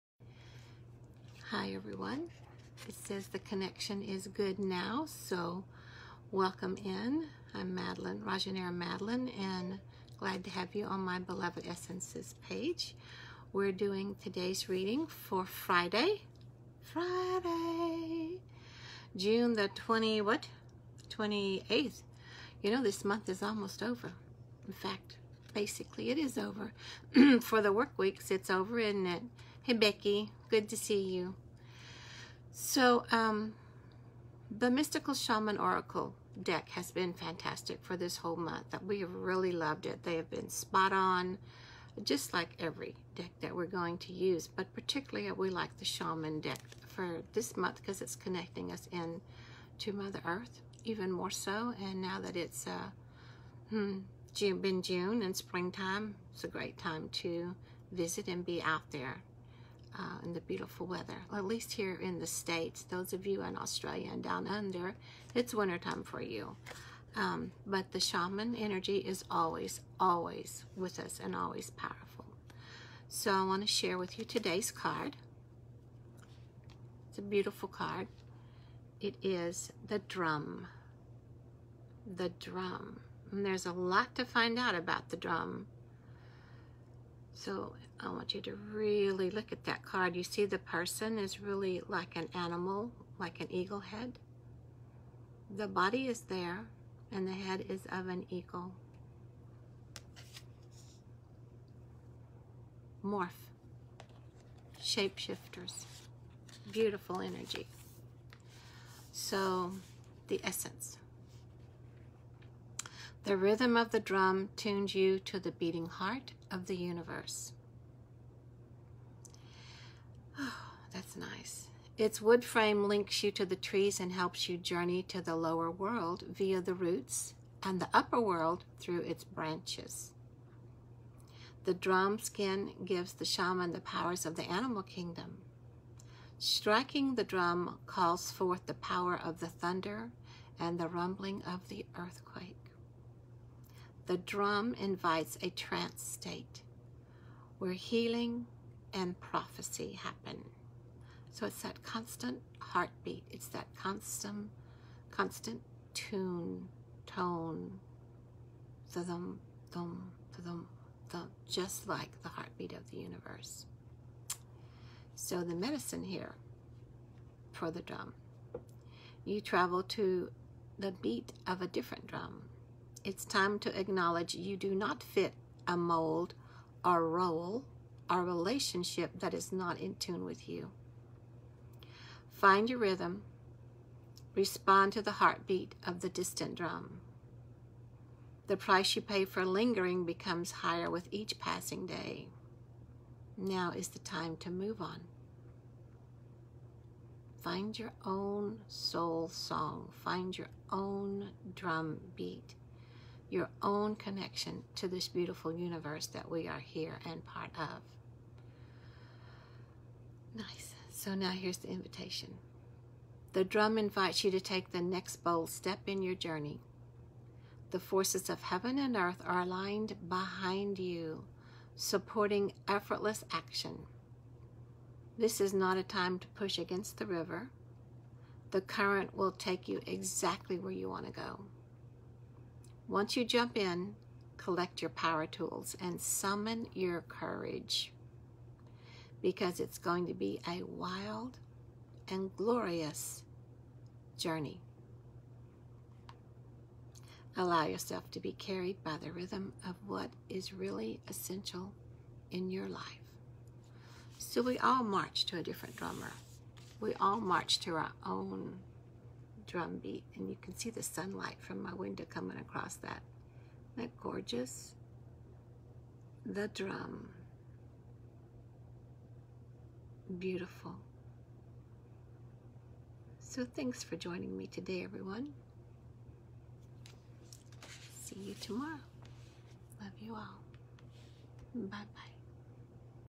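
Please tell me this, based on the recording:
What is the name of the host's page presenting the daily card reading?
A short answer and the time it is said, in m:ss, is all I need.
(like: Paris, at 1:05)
Beloved Essences, at 0:11.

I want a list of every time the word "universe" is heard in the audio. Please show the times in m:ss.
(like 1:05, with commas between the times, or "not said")
1:56, 2:42, 3:25.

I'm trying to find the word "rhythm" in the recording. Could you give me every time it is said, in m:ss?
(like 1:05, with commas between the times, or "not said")
1:53, 3:02, 4:09.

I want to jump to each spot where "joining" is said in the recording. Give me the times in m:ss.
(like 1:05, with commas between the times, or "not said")
4:33.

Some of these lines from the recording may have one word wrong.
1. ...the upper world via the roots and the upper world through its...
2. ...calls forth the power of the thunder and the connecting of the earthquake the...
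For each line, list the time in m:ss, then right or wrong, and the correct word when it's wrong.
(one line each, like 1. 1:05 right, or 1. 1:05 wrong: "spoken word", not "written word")
1. 2:05 wrong: "lower", not "upper"
2. 2:17 wrong: "rumbling", not "connecting".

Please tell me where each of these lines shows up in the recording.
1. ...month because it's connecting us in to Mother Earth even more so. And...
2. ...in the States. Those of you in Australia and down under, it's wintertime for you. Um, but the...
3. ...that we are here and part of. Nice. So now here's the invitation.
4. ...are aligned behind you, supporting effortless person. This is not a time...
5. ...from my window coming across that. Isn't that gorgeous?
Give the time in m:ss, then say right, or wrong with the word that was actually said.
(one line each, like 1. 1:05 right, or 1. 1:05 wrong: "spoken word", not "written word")
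1. 0:47 right
2. 1:01 right
3. 3:26 right
4. 3:39 wrong: "action", not "person"
5. 4:21 right.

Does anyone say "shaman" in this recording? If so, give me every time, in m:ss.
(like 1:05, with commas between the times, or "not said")
0:35, 0:45, 1:07, 2:13.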